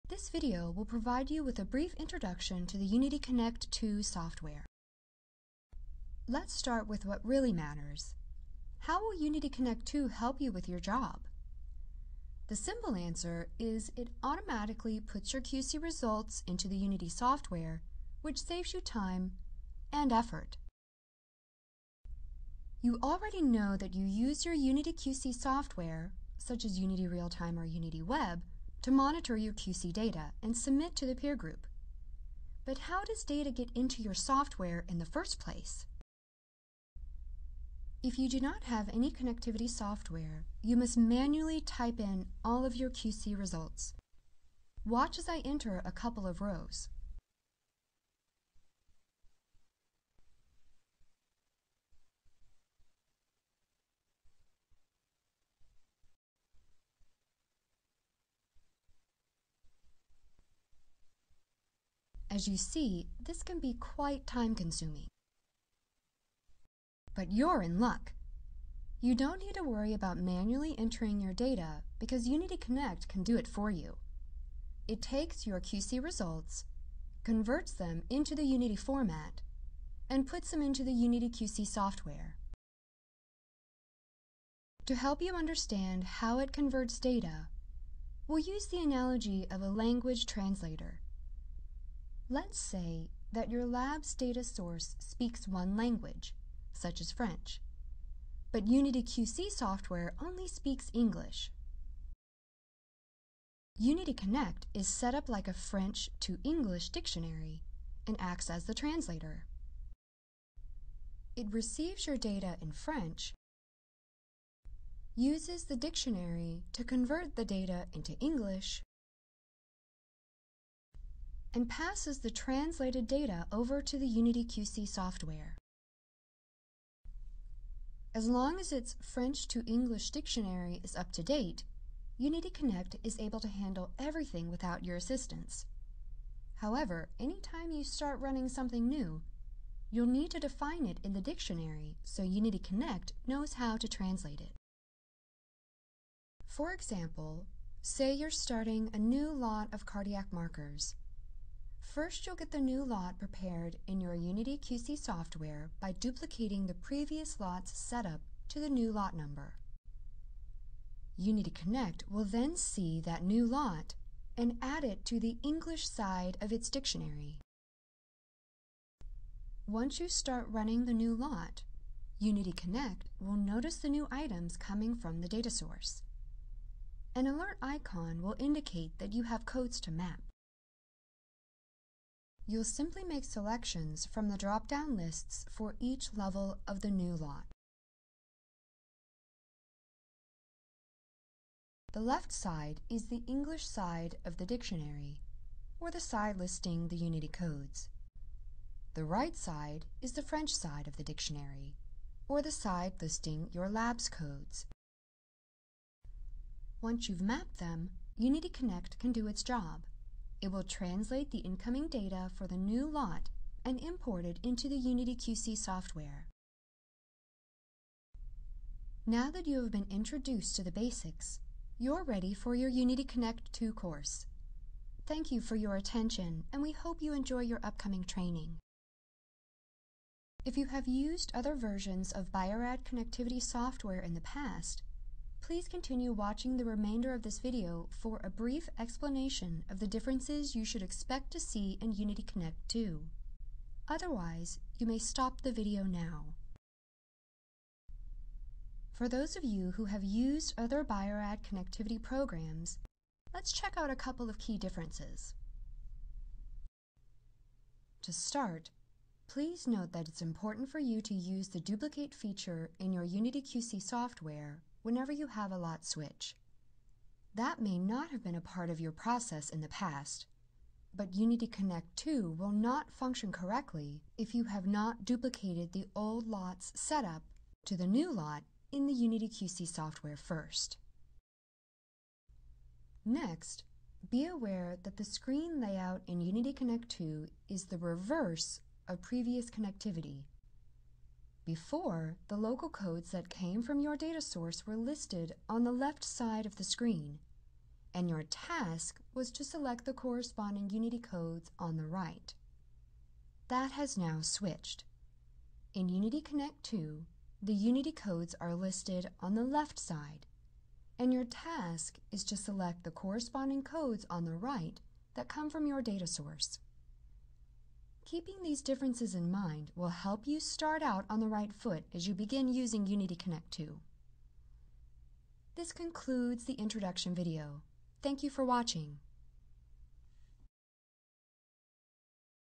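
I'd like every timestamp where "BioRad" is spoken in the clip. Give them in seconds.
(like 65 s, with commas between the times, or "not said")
250 s.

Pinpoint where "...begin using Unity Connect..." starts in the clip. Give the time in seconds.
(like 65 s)
322 s.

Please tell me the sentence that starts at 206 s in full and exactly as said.
Once you've mapped them, Unity Connect can do its job.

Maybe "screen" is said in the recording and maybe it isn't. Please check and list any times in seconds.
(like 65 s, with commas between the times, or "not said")
285 s, 296 s.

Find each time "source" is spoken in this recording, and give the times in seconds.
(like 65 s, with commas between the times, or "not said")
94 s, 175 s, 294 s, 316 s.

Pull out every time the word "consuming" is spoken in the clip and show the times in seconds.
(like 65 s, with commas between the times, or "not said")
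64 s.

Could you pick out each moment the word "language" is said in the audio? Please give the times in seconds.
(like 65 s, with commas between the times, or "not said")
89 s, 95 s.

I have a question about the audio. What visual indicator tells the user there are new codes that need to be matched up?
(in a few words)
An alert icon.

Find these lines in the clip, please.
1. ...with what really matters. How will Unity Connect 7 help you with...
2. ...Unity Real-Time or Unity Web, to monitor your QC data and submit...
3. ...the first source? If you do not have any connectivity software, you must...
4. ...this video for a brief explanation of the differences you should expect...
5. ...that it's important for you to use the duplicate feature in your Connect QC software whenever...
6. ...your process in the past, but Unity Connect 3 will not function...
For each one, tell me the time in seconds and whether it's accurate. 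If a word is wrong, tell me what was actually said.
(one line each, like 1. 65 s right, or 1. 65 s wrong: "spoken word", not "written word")
1. 6 s wrong: "2", not "7"
2. 26 s right
3. 34 s wrong: "place", not "source"
4. 237 s right
5. 259 s wrong: "Unity", not "Connect"
6. 268 s wrong: "2", not "3".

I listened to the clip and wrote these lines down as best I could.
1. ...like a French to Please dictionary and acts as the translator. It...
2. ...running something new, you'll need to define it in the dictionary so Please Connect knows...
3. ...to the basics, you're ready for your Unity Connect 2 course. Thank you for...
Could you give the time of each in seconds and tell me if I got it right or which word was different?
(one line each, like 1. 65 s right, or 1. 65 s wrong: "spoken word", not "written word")
1. 105 s wrong: "English", not "Please"
2. 138 s wrong: "Unity", not "Please"
3. 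220 s right.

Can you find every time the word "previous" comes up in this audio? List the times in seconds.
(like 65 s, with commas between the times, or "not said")
156 s, 289 s.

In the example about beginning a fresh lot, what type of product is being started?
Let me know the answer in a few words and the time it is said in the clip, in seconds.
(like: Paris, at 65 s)
Cardiac markers, at 149 s.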